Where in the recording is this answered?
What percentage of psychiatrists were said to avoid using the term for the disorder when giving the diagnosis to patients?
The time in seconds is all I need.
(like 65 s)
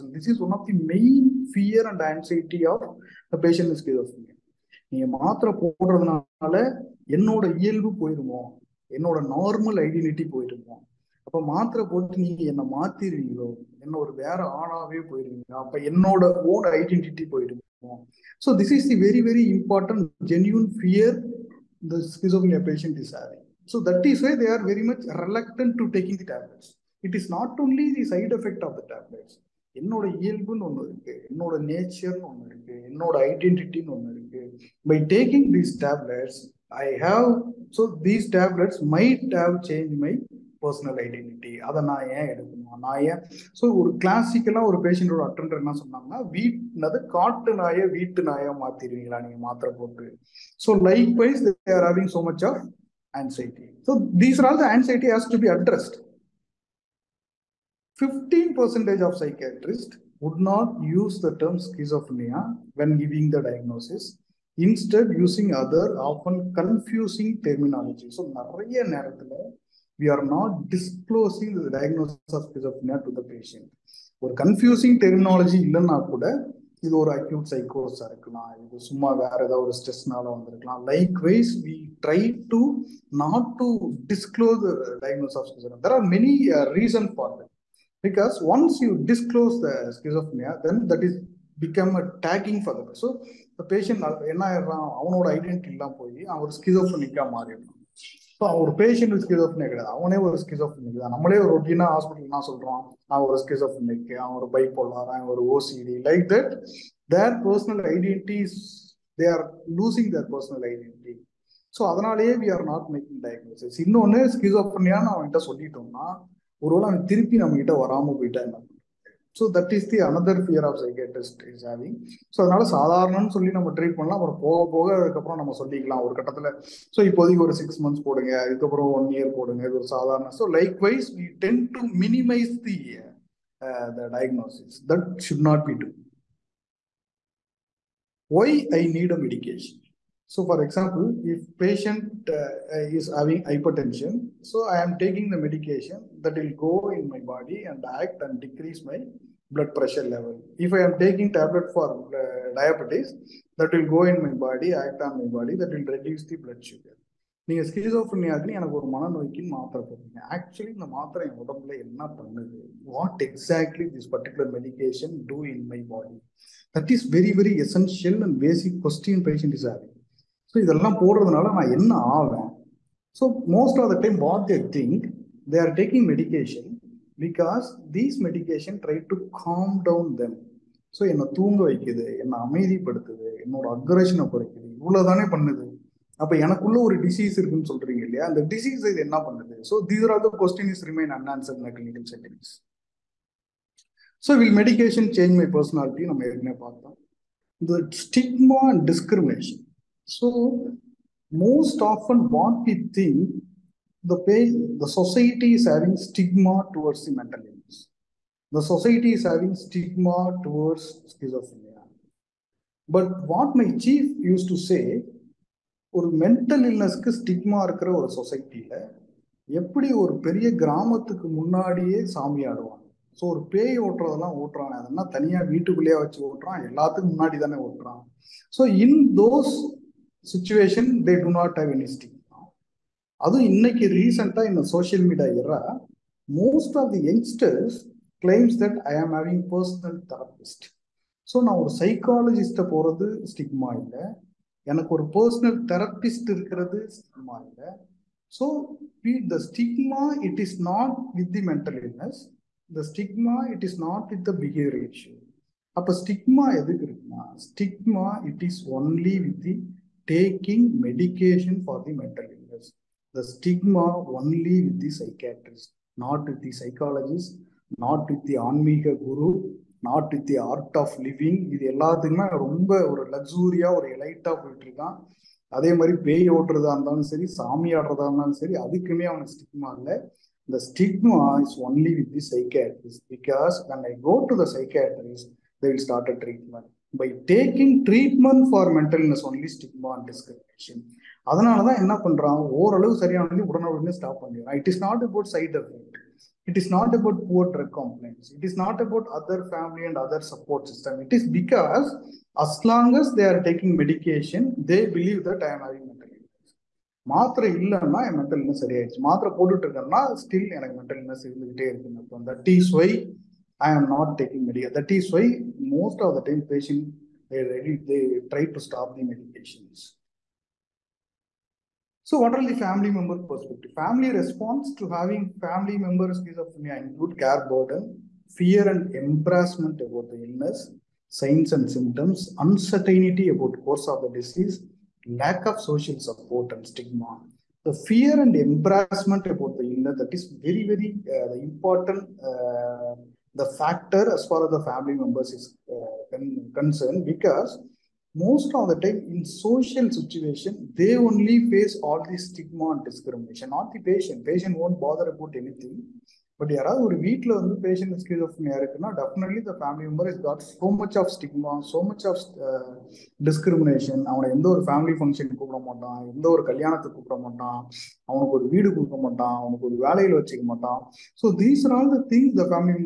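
57 s.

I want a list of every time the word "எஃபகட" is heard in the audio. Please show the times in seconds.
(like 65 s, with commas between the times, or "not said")
28 s, 295 s.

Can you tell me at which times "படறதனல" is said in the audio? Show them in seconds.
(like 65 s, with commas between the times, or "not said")
5 s, 171 s.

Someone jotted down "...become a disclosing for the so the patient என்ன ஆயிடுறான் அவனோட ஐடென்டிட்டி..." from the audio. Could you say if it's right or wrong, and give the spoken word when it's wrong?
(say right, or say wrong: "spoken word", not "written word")
wrong: "tagging", not "disclosing".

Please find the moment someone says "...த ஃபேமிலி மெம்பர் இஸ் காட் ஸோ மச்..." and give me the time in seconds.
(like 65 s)
359 s.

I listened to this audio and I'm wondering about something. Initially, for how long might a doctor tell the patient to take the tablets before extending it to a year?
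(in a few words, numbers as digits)
6 months.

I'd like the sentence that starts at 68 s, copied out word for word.
So, நிறைய நேரத்தில் we are not disclosing the diagnosis of schizophrenia to the patient.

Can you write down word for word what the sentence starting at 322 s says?
So what are the family member perspective?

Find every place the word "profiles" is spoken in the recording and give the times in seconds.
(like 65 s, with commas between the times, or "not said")
not said.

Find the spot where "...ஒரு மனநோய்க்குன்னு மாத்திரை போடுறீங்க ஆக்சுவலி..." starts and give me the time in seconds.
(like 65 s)
158 s.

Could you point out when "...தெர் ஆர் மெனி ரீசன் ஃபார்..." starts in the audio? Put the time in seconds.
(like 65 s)
85 s.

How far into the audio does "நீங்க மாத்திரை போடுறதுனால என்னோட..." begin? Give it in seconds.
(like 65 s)
4 s.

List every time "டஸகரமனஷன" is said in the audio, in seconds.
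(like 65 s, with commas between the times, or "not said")
198 s, 290 s, 363 s.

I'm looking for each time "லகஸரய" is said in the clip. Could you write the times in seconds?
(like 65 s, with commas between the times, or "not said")
273 s.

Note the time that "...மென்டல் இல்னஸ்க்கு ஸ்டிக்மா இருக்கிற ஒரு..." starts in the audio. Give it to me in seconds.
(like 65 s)
216 s.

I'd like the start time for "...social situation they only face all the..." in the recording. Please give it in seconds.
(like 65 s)
349 s.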